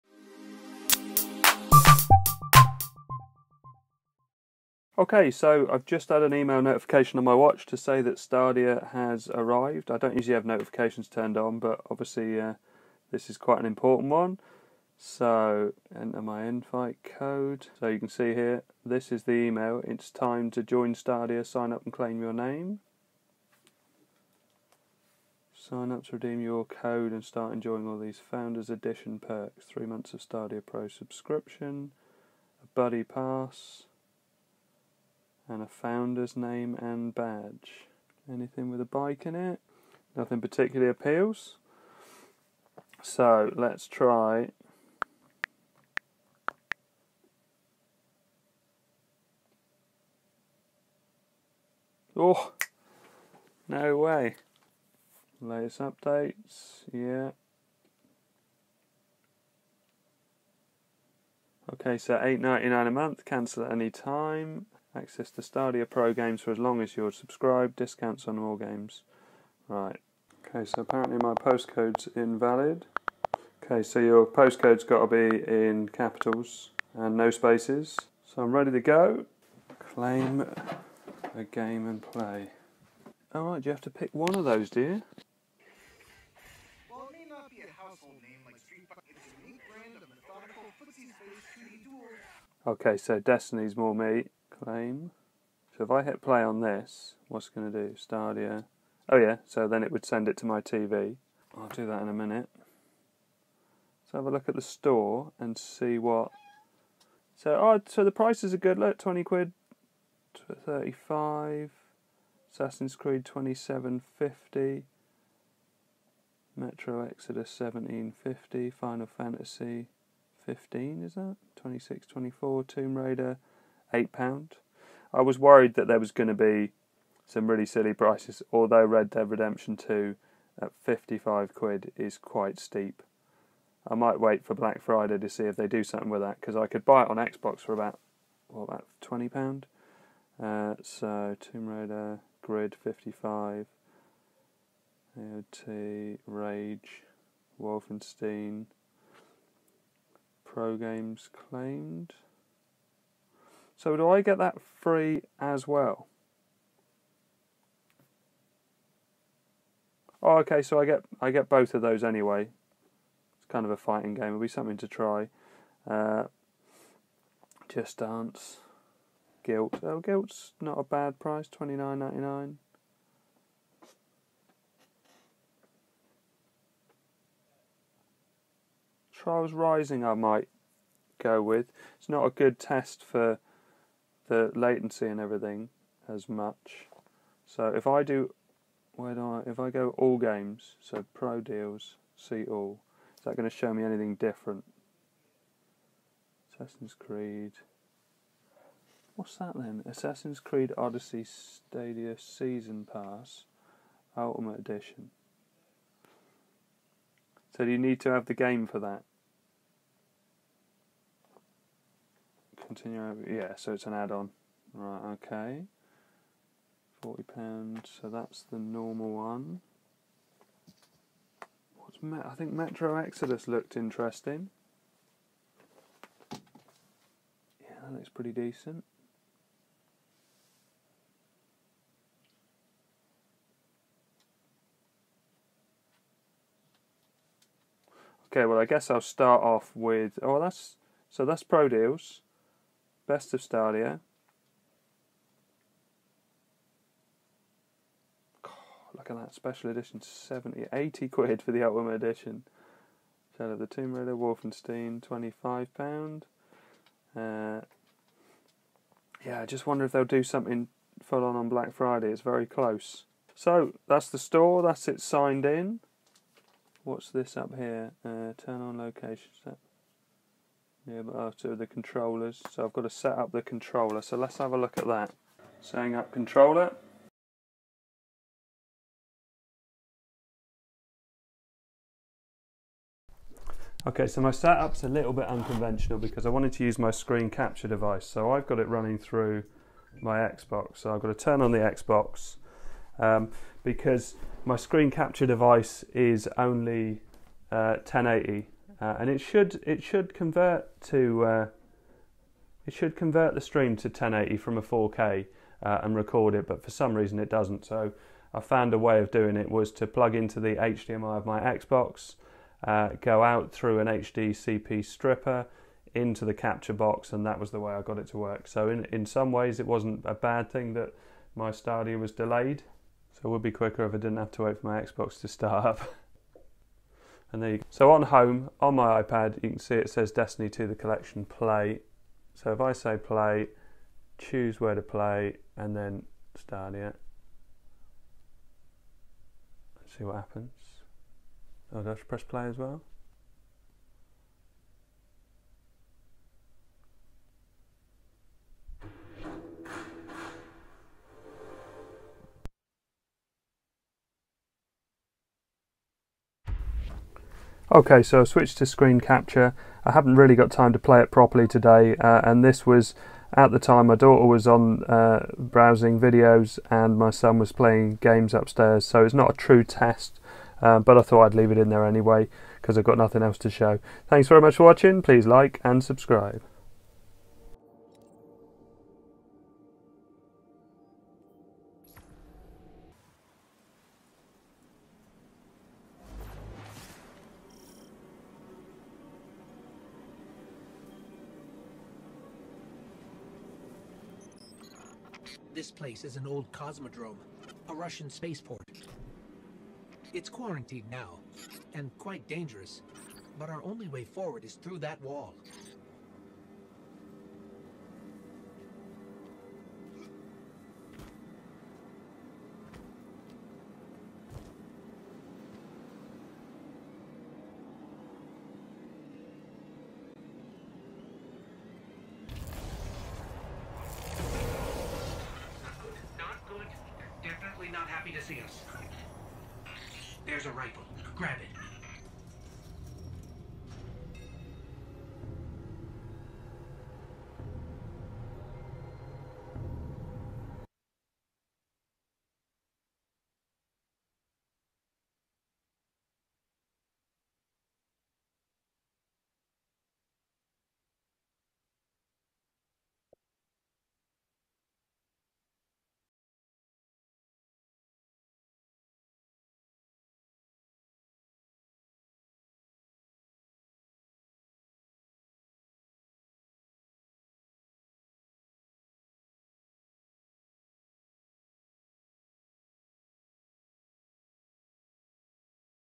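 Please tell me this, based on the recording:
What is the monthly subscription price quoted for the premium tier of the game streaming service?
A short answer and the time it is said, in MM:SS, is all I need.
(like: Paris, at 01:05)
8.99, at 01:02.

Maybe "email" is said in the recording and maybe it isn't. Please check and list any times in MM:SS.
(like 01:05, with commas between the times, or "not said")
00:06, 00:19.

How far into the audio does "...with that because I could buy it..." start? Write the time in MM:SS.
02:16.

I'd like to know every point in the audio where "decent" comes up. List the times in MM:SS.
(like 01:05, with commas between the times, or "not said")
03:48.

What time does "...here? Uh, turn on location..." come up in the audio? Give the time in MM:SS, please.
04:27.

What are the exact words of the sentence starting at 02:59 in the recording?
Trials Rising, I might go with.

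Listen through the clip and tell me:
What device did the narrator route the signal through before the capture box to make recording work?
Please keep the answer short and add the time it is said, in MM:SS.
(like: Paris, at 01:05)
HDCP stripper, at 05:13.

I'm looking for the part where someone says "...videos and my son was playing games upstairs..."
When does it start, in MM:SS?
06:05.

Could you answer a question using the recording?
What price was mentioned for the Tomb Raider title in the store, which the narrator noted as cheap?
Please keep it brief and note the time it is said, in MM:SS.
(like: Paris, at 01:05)
£8, at 02:03.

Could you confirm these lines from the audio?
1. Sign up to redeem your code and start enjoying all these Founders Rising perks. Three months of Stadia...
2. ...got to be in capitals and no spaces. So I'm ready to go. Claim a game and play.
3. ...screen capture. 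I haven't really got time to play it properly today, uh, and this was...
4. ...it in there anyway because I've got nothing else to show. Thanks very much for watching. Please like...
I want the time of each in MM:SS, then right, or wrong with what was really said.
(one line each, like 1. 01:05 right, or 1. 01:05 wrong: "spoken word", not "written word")
1. 00:25 wrong: "Edition", not "Rising"
2. 01:14 right
3. 05:58 right
4. 06:11 right.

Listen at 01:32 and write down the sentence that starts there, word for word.
Okay, so Destiny's more me claim.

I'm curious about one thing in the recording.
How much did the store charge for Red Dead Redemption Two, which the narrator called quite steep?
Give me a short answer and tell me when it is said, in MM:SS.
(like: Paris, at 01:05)
£55, at 02:10.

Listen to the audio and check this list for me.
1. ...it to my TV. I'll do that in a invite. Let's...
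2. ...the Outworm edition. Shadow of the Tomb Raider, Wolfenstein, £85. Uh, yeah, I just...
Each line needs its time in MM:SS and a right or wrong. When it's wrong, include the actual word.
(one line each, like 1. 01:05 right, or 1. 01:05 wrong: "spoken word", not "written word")
1. 01:40 wrong: "minute", not "invite"
2. 04:11 wrong: "25", not "85".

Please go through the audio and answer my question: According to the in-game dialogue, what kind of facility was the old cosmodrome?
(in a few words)
Russian spaceport.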